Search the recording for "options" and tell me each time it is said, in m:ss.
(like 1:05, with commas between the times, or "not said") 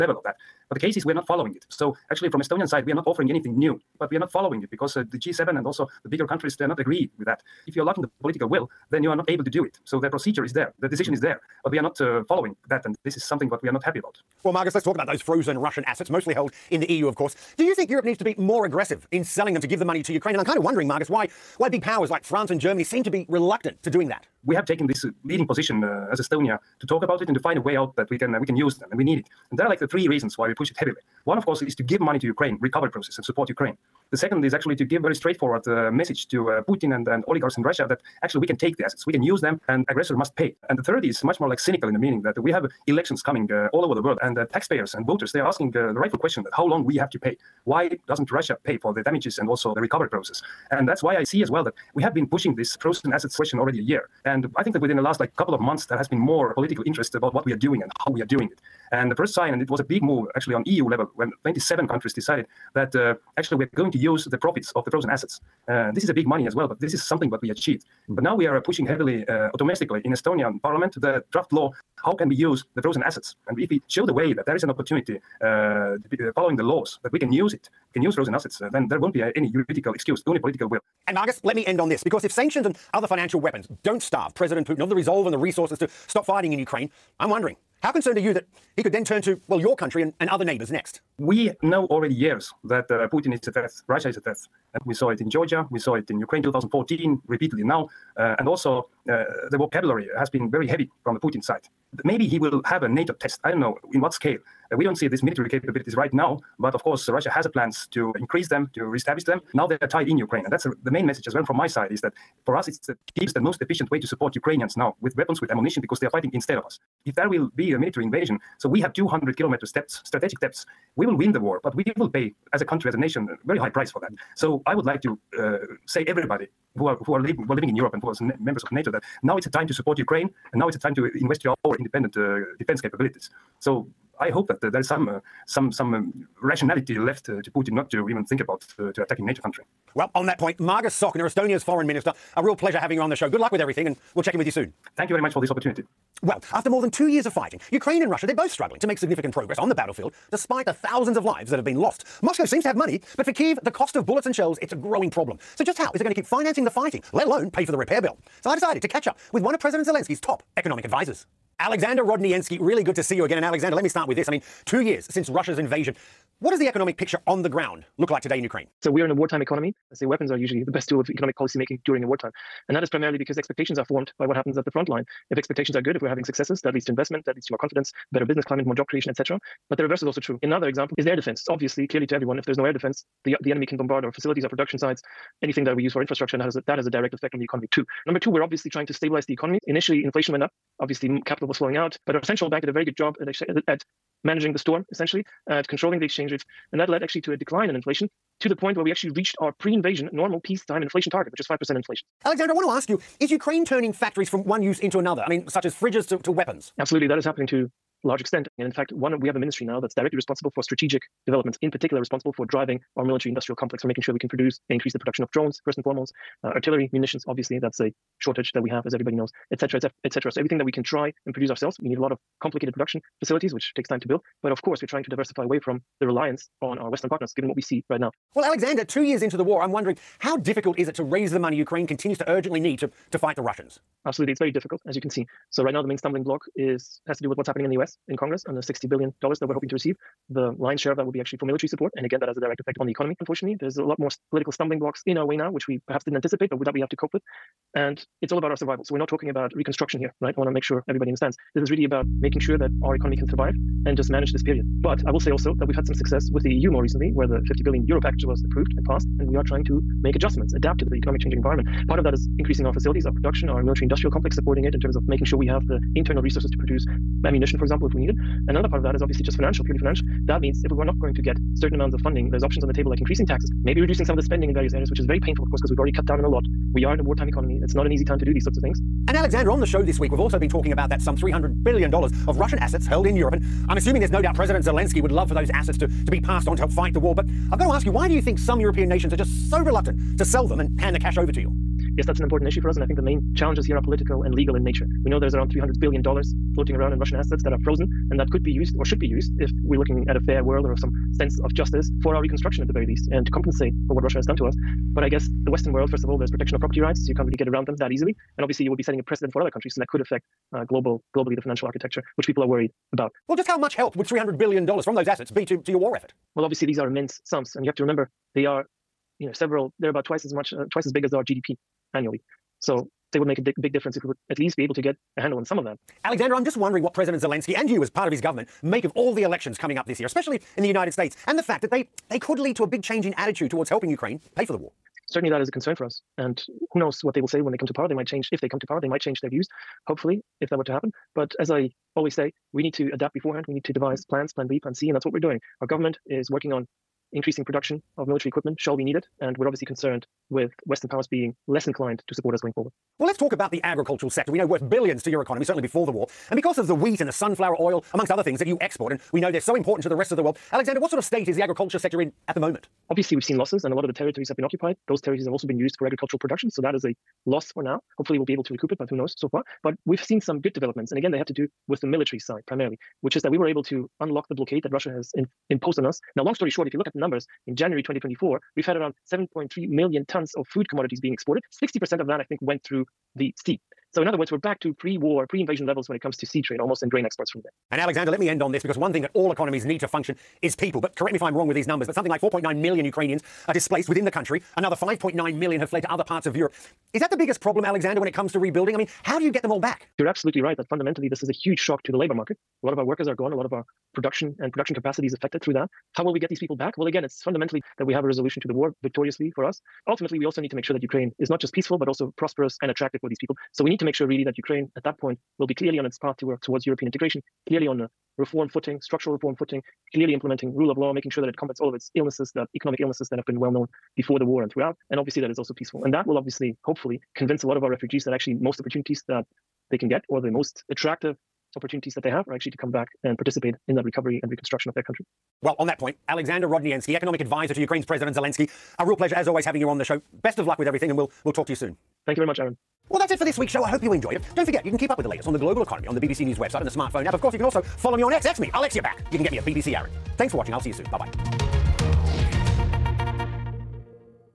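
4:32.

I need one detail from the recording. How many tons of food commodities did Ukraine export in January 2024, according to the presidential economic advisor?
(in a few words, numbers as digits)
7.3 million tons.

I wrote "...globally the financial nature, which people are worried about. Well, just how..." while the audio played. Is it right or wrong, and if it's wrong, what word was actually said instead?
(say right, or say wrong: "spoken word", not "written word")
wrong: "architecture", not "nature".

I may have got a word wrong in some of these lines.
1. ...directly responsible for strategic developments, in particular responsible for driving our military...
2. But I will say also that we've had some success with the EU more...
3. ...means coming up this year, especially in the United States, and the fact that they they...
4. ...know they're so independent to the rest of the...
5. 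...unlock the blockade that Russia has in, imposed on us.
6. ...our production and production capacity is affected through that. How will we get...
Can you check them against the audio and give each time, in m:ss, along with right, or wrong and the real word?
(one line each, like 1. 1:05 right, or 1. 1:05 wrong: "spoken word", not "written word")
1. 3:29 right
2. 4:14 right
3. 5:29 wrong: "elections", not "means"
4. 5:59 wrong: "important", not "independent"
5. 6:14 right
6. 6:43 right.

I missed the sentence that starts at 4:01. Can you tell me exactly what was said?
And again, that has a direct effect on the economy.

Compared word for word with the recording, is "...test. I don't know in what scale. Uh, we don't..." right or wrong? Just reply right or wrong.
right.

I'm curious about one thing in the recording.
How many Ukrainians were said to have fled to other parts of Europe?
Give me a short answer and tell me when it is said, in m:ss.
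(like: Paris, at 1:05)
5.9 million, at 6:34.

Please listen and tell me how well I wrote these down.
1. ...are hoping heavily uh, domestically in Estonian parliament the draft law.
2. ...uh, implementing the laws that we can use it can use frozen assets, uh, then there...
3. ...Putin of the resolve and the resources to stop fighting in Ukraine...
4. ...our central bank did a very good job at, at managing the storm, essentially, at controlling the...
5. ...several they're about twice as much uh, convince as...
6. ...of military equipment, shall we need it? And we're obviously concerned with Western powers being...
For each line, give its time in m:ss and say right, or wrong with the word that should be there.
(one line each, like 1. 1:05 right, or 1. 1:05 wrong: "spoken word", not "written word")
1. 1:08 wrong: "pushing", not "hoping"
2. 1:16 wrong: "following", not "implementing"
3. 1:24 right
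4. 3:12 right
5. 5:19 wrong: "twice", not "convince"
6. 5:47 right.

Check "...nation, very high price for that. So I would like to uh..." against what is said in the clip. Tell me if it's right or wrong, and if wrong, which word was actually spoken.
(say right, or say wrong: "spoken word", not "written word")
right.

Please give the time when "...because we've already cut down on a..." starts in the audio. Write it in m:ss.
4:35.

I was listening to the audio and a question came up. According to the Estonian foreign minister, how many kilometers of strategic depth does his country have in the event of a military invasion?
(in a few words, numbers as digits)
200 kilometers.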